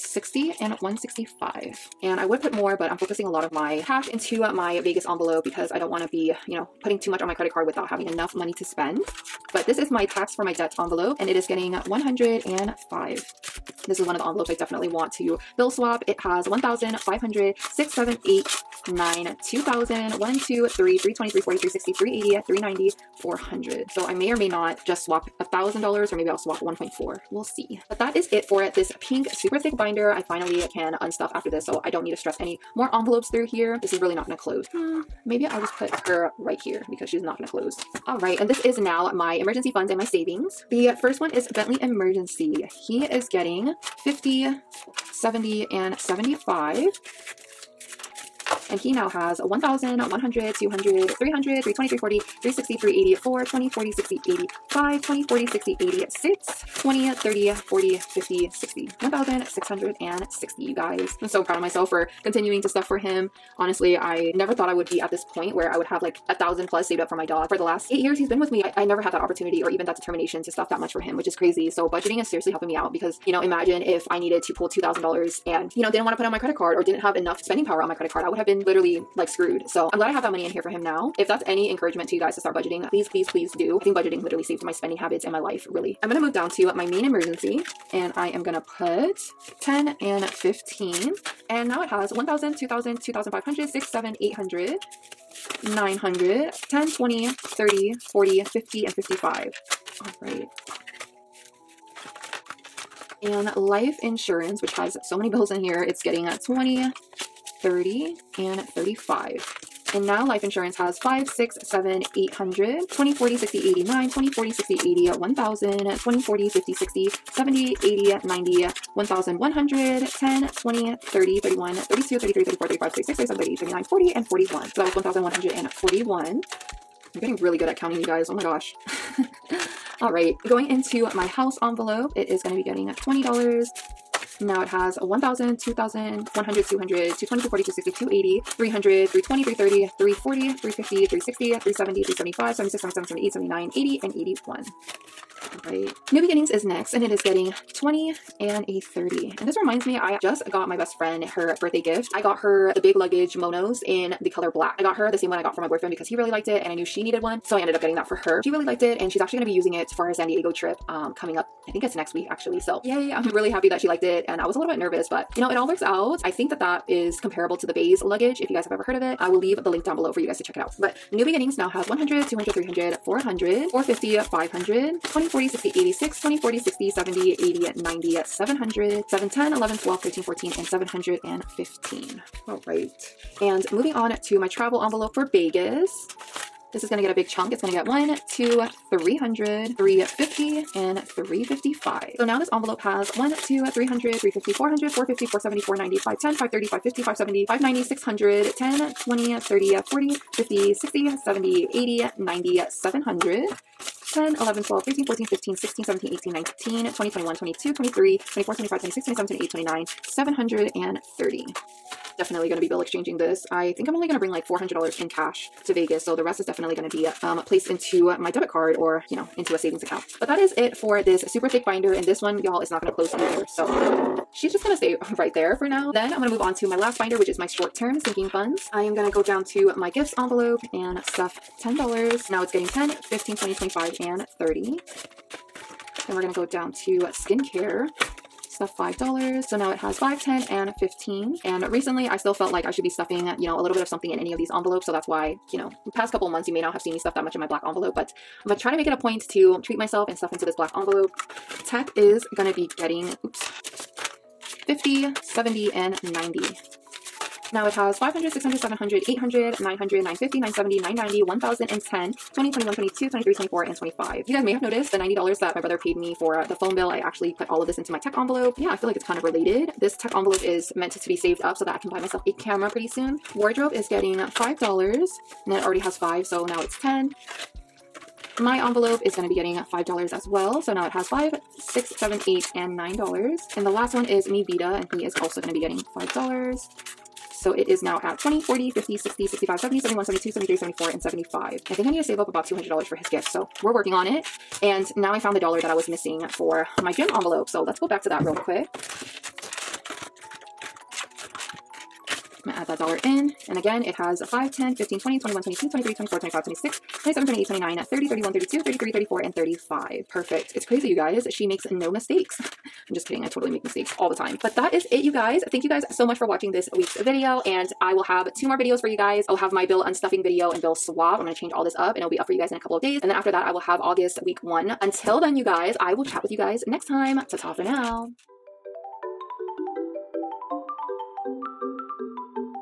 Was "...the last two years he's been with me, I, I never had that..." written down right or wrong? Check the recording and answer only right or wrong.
wrong.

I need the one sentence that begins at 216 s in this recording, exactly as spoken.
So the rest is definitely going to be um, placed into my debit card or, you know, into a savings account.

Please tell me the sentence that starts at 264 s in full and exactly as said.
You guys may have noticed the $90 that my brother paid me for the phone bill.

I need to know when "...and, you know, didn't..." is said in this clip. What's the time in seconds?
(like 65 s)
75 s.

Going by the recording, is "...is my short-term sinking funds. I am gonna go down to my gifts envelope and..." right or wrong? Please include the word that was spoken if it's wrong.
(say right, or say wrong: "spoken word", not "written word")
right.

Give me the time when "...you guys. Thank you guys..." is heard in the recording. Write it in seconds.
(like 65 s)
315 s.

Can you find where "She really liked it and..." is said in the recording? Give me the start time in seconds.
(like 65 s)
158 s.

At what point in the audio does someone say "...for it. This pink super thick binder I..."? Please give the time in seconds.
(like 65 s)
28 s.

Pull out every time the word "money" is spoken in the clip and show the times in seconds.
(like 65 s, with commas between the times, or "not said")
8 s, 80 s.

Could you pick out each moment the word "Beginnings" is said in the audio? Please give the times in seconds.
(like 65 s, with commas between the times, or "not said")
146 s, 171 s.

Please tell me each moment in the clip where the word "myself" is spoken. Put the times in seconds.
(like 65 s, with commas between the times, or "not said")
249 s, 271 s.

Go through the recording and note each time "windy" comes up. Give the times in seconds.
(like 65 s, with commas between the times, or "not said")
not said.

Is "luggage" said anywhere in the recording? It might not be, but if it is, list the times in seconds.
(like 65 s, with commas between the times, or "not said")
152 s, 168 s.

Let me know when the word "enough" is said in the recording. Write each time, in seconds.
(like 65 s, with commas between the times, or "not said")
8 s, 77 s.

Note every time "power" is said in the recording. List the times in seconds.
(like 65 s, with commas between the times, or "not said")
77 s.